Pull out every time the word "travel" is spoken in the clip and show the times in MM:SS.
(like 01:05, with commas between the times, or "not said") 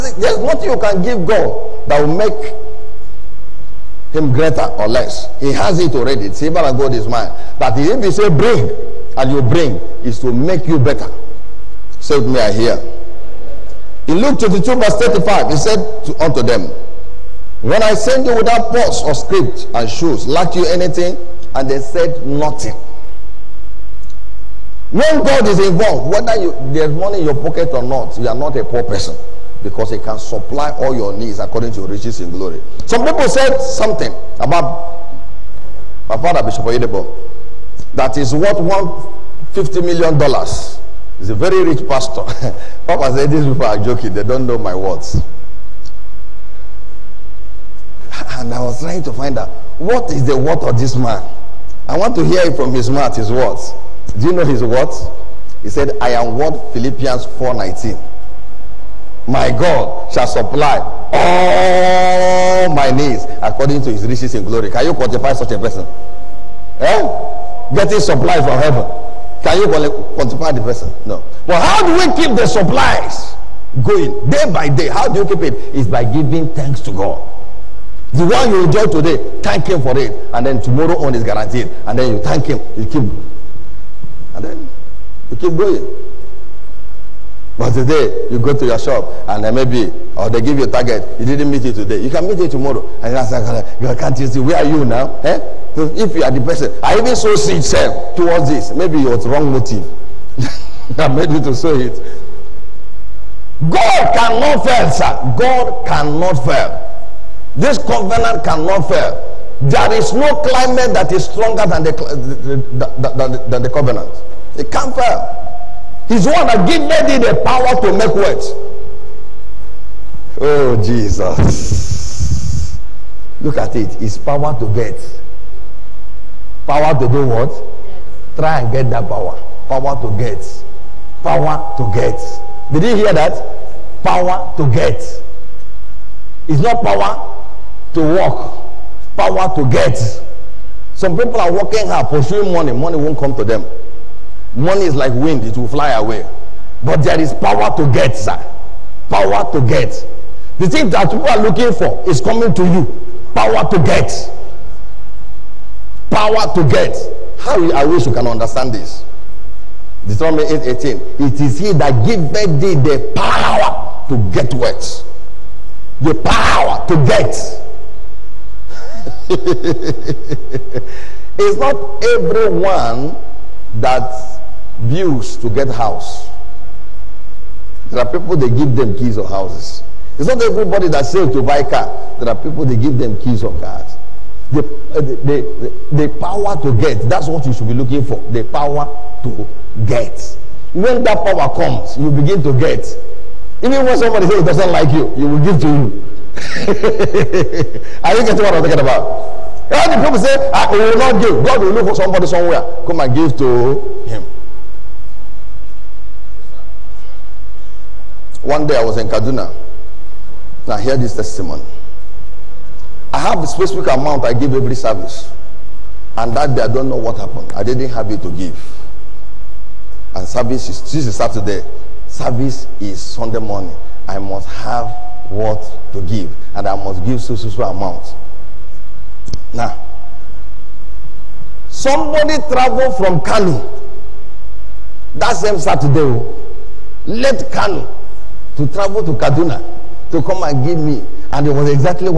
03:52, 03:58.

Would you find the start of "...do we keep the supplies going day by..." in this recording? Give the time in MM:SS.
01:11.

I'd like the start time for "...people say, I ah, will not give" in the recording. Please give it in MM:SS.
03:20.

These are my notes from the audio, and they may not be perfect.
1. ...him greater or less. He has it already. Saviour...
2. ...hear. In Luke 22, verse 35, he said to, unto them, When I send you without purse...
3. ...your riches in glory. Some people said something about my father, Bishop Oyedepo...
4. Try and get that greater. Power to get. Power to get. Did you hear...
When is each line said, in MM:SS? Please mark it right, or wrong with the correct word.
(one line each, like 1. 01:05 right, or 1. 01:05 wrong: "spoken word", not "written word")
1. 00:04 right
2. 00:12 right
3. 00:31 right
4. 02:08 wrong: "power", not "greater".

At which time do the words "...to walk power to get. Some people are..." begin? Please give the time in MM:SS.
02:17.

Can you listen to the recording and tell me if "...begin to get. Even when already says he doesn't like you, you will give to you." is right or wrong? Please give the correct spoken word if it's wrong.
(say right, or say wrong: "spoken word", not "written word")
wrong: "somebody", not "already".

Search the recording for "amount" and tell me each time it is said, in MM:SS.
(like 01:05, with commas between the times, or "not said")
03:33, 03:47.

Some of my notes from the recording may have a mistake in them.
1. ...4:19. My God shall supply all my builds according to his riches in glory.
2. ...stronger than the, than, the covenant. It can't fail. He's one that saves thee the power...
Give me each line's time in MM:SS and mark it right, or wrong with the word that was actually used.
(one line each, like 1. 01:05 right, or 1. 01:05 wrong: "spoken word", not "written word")
1. 00:57 wrong: "needs", not "builds"
2. 01:51 wrong: "gives", not "saves".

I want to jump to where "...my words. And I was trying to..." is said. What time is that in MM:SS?
00:44.